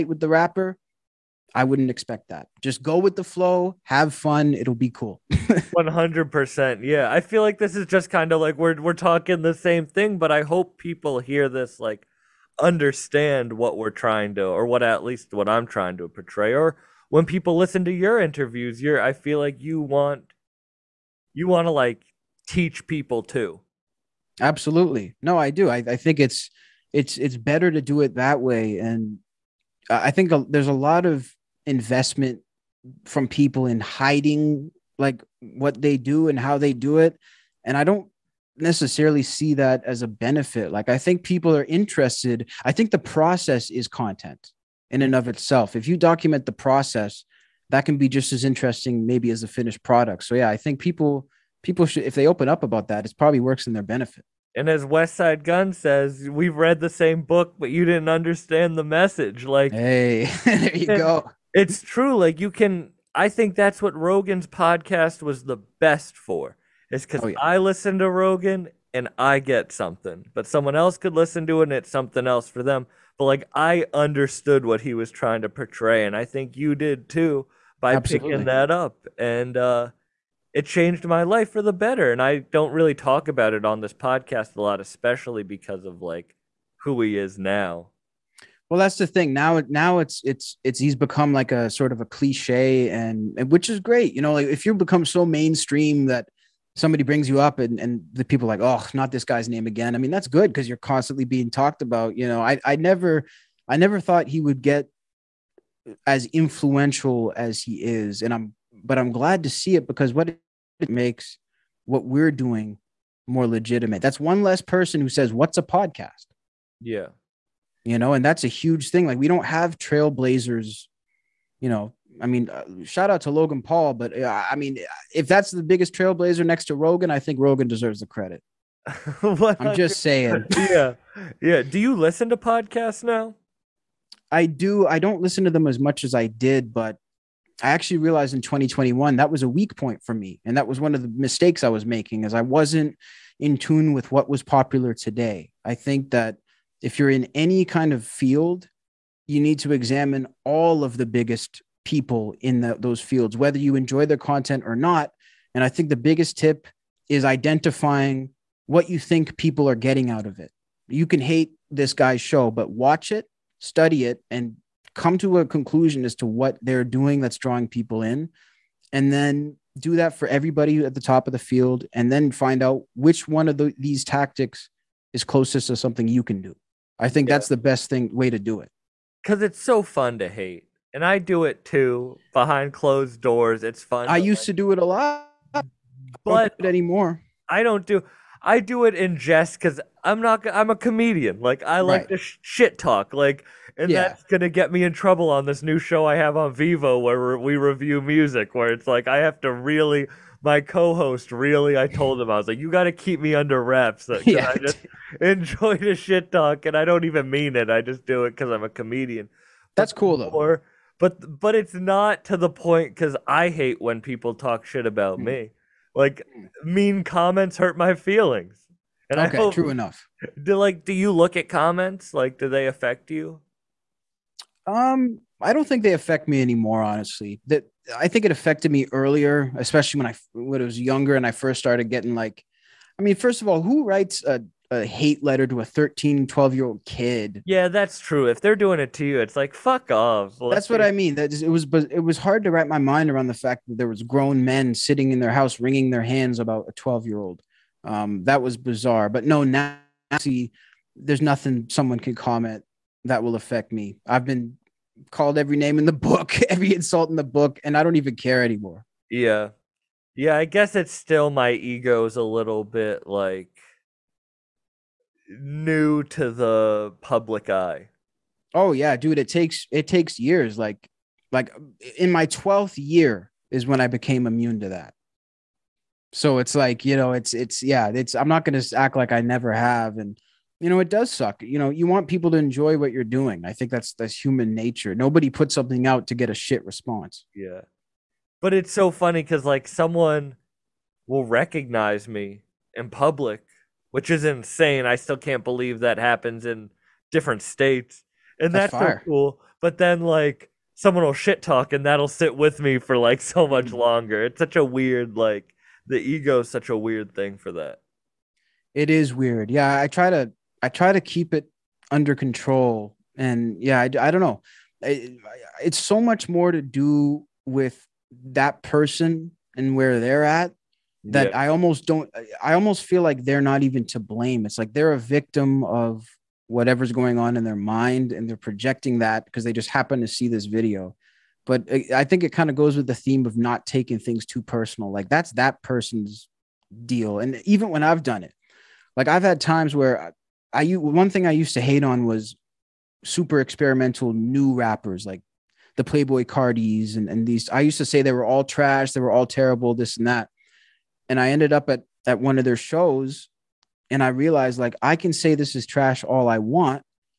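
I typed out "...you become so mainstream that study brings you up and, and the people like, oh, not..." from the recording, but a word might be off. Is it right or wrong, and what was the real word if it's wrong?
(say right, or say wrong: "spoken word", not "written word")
wrong: "somebody", not "study".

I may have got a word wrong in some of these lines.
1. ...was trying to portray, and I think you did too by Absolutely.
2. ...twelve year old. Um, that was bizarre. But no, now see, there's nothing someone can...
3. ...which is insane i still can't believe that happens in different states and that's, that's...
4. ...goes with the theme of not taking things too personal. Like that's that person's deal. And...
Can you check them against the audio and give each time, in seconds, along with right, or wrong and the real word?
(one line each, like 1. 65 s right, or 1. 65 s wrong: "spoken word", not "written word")
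1. 74 s right
2. 246 s right
3. 293 s right
4. 332 s right.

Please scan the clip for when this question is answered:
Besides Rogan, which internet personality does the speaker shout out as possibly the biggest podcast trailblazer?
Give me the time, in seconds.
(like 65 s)
123 s.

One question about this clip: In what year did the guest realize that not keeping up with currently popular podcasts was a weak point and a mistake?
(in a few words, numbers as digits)
2021.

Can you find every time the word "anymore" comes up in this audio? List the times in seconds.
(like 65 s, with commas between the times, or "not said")
186 s, 226 s, 258 s.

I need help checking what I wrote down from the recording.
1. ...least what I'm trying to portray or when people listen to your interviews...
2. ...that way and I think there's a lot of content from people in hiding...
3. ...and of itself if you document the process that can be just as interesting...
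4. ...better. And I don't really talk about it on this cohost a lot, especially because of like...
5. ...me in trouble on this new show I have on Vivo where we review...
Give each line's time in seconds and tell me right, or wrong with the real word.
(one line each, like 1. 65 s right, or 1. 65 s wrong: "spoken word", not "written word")
1. 15 s right
2. 28 s wrong: "investment", not "content"
3. 45 s right
4. 81 s wrong: "podcast", not "cohost"
5. 194 s right.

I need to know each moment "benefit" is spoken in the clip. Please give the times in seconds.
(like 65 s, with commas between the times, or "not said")
40 s, 53 s.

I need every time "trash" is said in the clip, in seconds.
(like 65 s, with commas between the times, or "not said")
348 s, 355 s.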